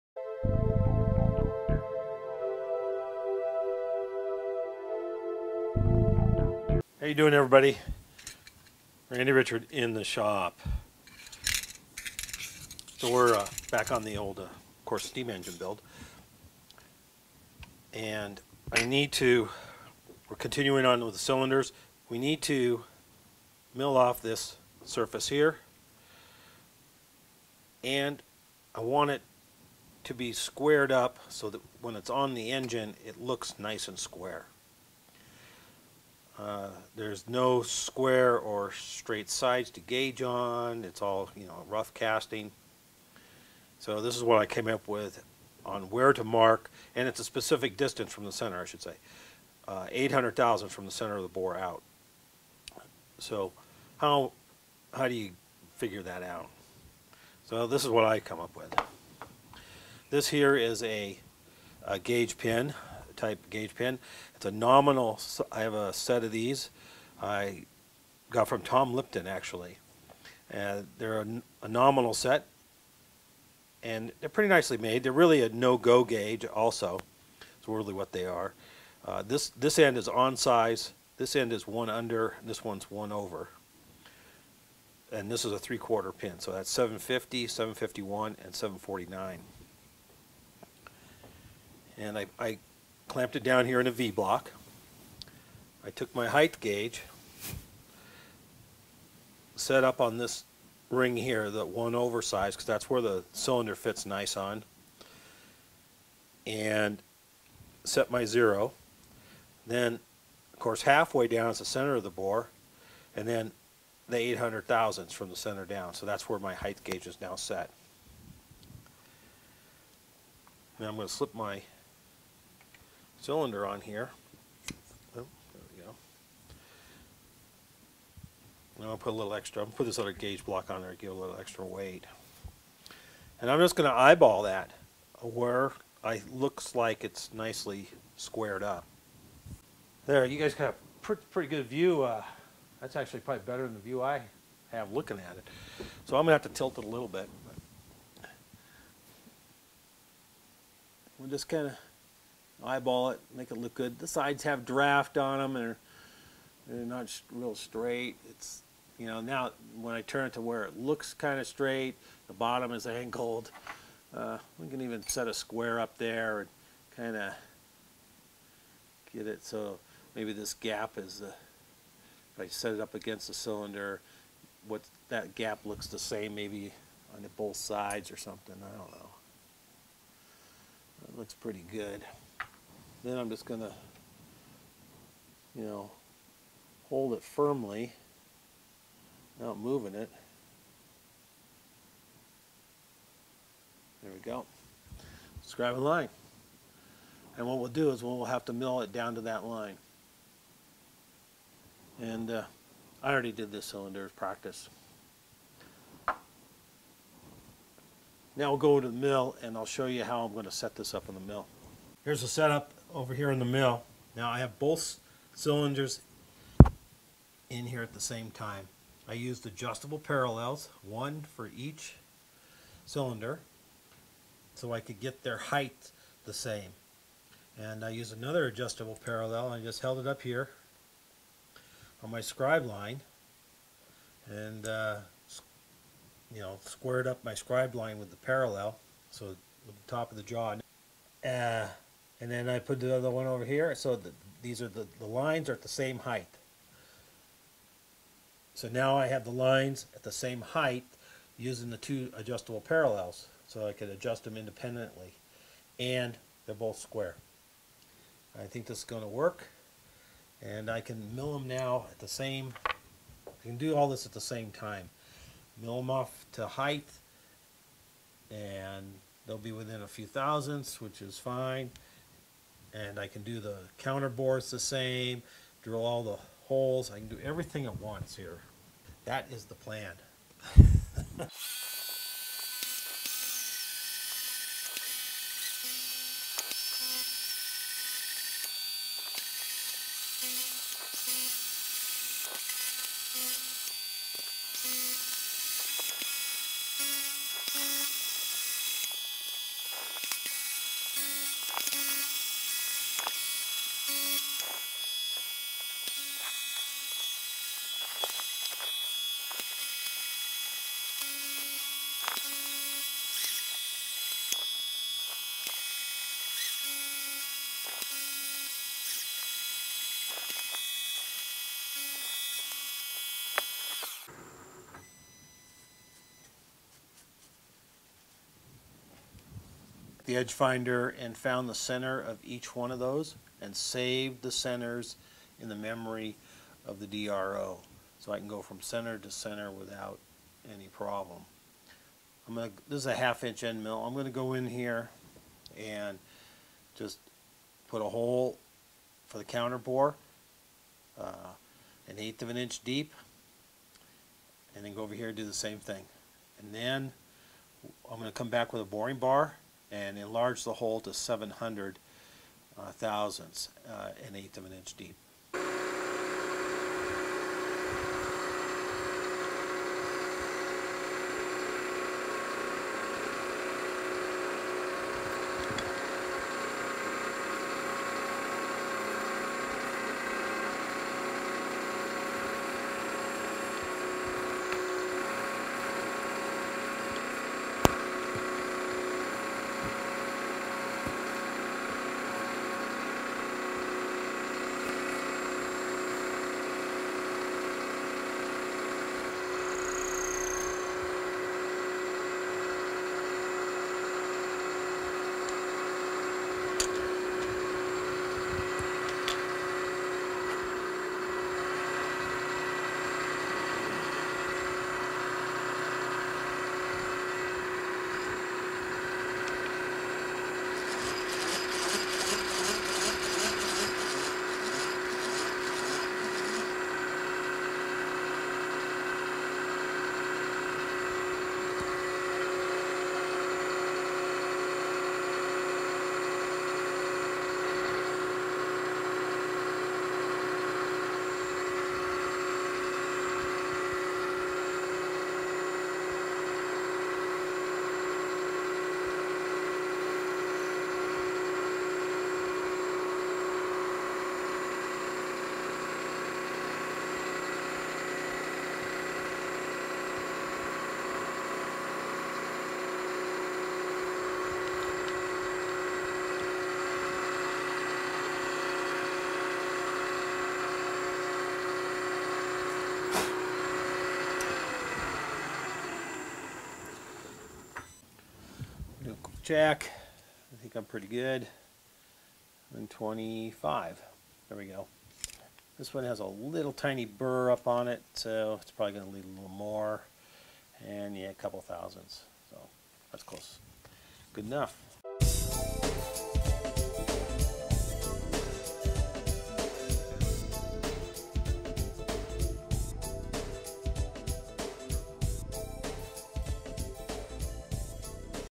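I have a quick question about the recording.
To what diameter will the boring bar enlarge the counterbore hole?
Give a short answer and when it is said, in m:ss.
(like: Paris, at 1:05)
700 thousandths, at 6:00.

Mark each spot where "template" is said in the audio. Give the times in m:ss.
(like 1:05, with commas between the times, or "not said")
not said.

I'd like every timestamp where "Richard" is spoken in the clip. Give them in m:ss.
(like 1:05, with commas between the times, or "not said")
0:09.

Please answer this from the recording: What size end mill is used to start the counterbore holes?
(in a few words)
Half inch.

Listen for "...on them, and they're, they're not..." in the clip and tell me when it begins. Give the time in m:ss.
2:35.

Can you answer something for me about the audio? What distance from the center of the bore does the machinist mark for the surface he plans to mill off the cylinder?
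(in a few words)
800 thousandths.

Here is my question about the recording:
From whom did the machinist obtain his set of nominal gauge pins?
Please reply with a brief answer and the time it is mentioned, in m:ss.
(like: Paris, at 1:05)
Tom Lipton, at 1:08.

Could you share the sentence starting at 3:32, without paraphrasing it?
Here's the setup over here in the mill.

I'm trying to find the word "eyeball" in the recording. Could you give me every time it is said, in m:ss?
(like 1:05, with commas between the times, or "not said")
2:13, 2:32.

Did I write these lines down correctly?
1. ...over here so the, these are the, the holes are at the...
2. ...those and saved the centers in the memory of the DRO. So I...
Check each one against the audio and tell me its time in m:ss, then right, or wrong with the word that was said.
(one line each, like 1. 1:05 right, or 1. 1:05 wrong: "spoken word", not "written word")
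1. 4:03 wrong: "lines", not "holes"
2. 5:32 right.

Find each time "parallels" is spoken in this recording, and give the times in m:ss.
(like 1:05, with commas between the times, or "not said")
3:39, 3:49, 3:58, 4:12.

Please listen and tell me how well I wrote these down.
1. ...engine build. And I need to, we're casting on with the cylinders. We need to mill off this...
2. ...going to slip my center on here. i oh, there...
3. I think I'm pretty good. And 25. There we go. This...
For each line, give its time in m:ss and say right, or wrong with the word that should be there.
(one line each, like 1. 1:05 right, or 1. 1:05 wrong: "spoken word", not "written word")
1. 0:15 wrong: "continuing", not "casting"
2. 2:00 wrong: "cylinder", not "center"
3. 8:00 right.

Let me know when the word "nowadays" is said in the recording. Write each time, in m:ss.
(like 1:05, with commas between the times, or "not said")
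not said.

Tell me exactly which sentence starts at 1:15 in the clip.
They're really a no-go gauge also.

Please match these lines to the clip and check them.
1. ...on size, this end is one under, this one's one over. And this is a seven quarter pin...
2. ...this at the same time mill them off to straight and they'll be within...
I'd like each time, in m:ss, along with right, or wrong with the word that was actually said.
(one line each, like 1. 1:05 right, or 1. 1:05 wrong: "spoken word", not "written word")
1. 1:20 wrong: "three", not "seven"
2. 4:23 wrong: "height", not "straight".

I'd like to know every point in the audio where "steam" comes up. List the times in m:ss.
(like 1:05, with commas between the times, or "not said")
0:15.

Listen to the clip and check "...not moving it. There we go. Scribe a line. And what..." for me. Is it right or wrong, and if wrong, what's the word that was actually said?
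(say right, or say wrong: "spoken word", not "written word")
right.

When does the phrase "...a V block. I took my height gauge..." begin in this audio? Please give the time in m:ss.
1:33.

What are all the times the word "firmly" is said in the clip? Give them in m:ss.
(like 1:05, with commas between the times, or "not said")
3:07.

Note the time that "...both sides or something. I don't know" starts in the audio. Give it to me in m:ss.
2:57.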